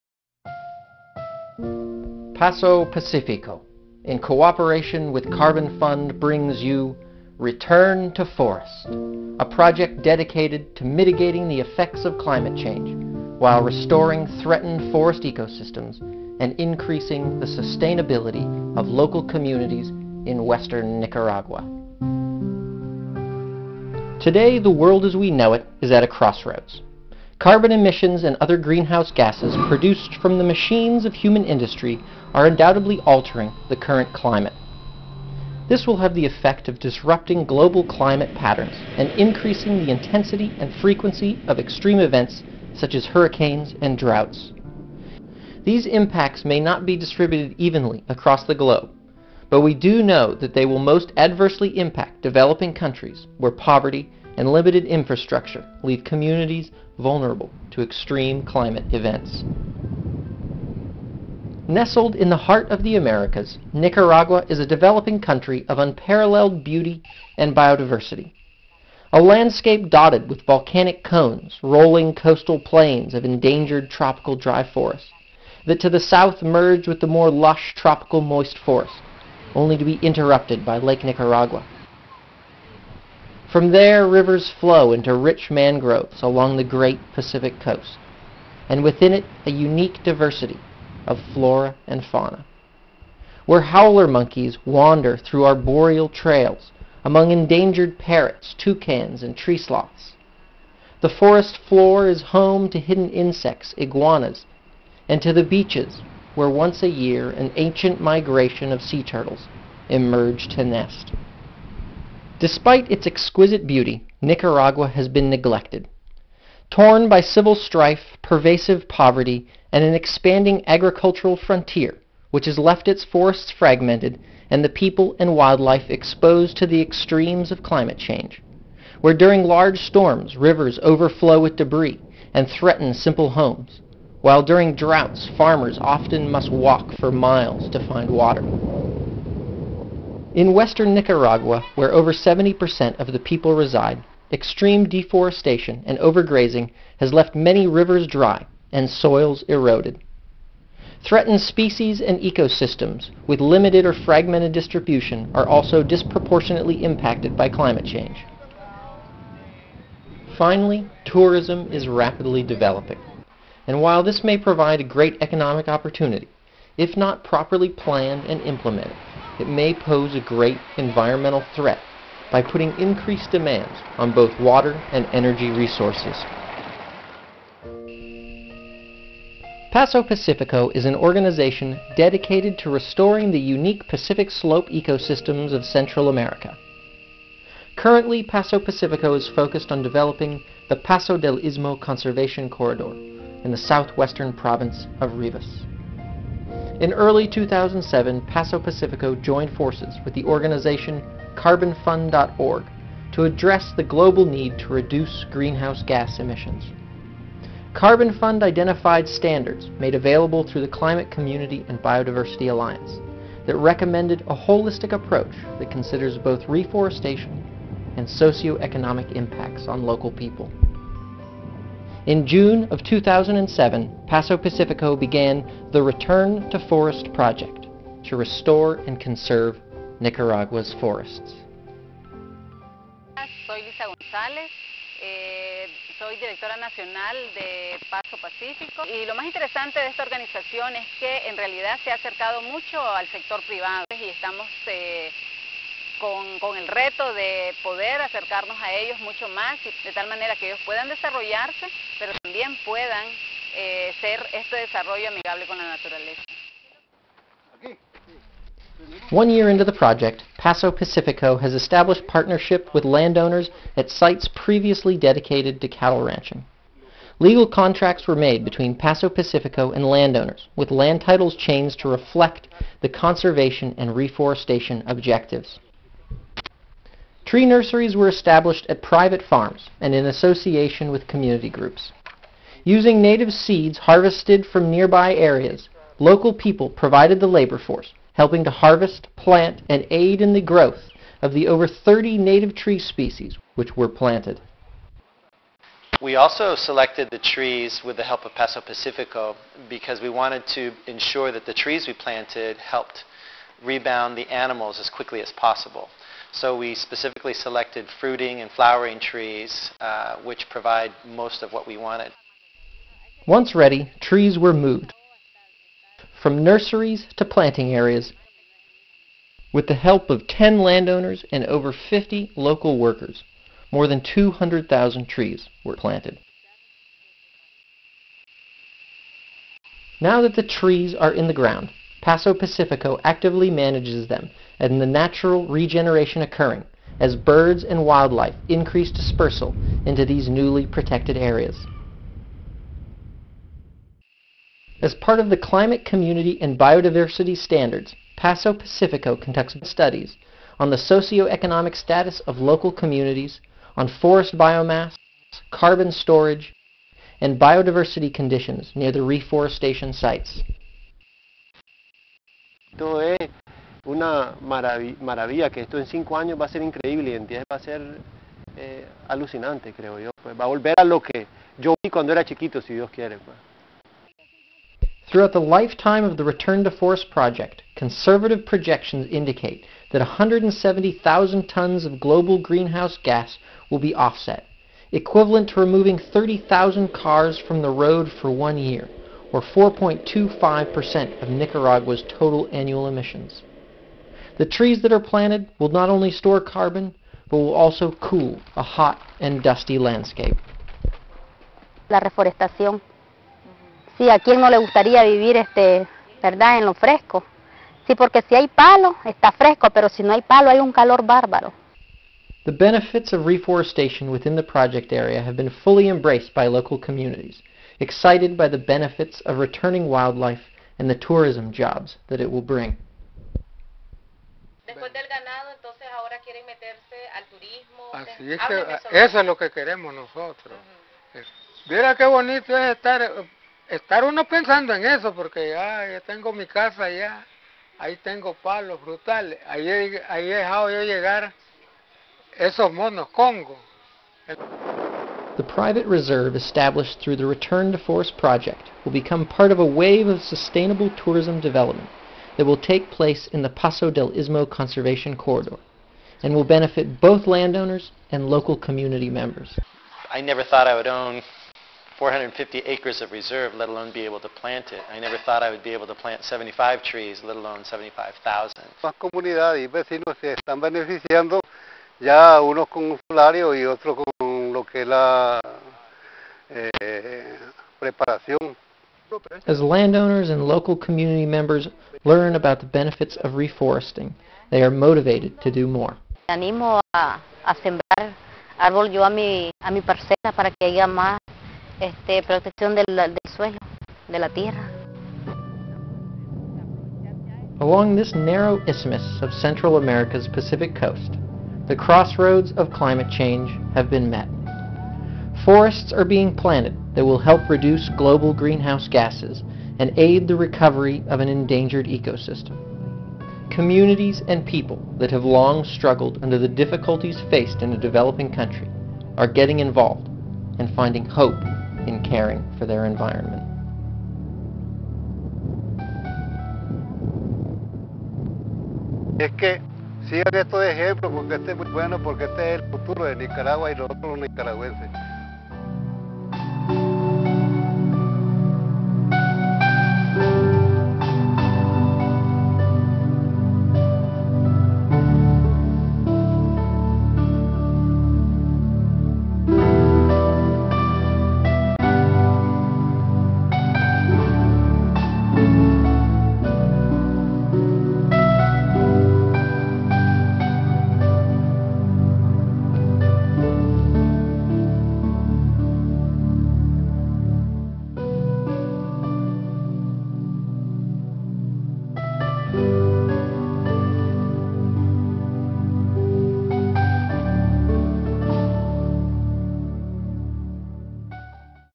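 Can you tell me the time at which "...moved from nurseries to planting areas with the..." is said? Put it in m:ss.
5:14.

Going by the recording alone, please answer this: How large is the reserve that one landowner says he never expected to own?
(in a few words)
450 acres.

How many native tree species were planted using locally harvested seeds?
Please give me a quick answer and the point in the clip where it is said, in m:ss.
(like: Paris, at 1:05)
over 30, at 4:51.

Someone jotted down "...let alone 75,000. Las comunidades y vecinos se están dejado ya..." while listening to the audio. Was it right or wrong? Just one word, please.
wrong.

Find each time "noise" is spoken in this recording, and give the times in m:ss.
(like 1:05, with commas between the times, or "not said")
not said.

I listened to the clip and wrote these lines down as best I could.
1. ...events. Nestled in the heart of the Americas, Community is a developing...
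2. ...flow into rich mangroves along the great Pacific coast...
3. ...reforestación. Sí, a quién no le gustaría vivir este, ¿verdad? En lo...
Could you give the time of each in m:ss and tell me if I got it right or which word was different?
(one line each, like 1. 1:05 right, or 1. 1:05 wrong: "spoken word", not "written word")
1. 0:58 wrong: "Nicaragua", not "Community"
2. 1:24 right
3. 6:41 right.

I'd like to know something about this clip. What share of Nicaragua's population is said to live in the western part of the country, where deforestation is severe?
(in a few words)
70%.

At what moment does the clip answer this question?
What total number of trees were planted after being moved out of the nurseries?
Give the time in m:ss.
5:24.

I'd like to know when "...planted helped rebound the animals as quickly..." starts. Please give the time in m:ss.
5:01.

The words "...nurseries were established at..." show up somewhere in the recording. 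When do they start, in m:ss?
4:37.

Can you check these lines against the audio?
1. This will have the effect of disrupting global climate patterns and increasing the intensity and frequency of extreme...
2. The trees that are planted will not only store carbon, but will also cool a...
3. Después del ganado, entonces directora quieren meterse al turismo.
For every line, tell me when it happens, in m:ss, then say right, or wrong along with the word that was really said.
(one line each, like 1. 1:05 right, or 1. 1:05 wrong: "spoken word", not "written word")
1. 0:35 right
2. 6:34 right
3. 7:04 wrong: "ahora", not "directora".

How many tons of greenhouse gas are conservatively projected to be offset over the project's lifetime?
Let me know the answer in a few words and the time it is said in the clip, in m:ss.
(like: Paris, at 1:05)
170,000, at 6:20.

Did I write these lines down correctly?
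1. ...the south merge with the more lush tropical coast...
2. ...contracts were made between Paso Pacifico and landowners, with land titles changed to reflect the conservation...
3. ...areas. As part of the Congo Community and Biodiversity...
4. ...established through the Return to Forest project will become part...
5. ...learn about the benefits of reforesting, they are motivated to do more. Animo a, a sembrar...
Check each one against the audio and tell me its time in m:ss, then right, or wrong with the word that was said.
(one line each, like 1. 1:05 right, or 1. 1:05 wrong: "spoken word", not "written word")
1. 1:15 wrong: "moist", not "coast"
2. 4:27 right
3. 5:41 wrong: "Climate", not "Congo"
4. 7:26 right
5. 8:02 right.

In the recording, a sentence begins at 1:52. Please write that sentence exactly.
Despite its exquisite beauty, Nicaragua has been neglected.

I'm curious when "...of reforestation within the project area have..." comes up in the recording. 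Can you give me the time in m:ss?
6:53.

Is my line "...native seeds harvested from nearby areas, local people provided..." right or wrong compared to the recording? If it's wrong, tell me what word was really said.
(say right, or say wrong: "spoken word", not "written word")
right.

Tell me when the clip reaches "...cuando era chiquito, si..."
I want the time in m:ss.
6:11.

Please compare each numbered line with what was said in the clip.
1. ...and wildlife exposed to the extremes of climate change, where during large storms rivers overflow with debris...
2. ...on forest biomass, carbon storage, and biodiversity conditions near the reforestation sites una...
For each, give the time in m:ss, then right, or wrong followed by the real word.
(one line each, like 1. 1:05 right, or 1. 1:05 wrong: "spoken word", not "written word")
1. 2:05 right
2. 5:53 right.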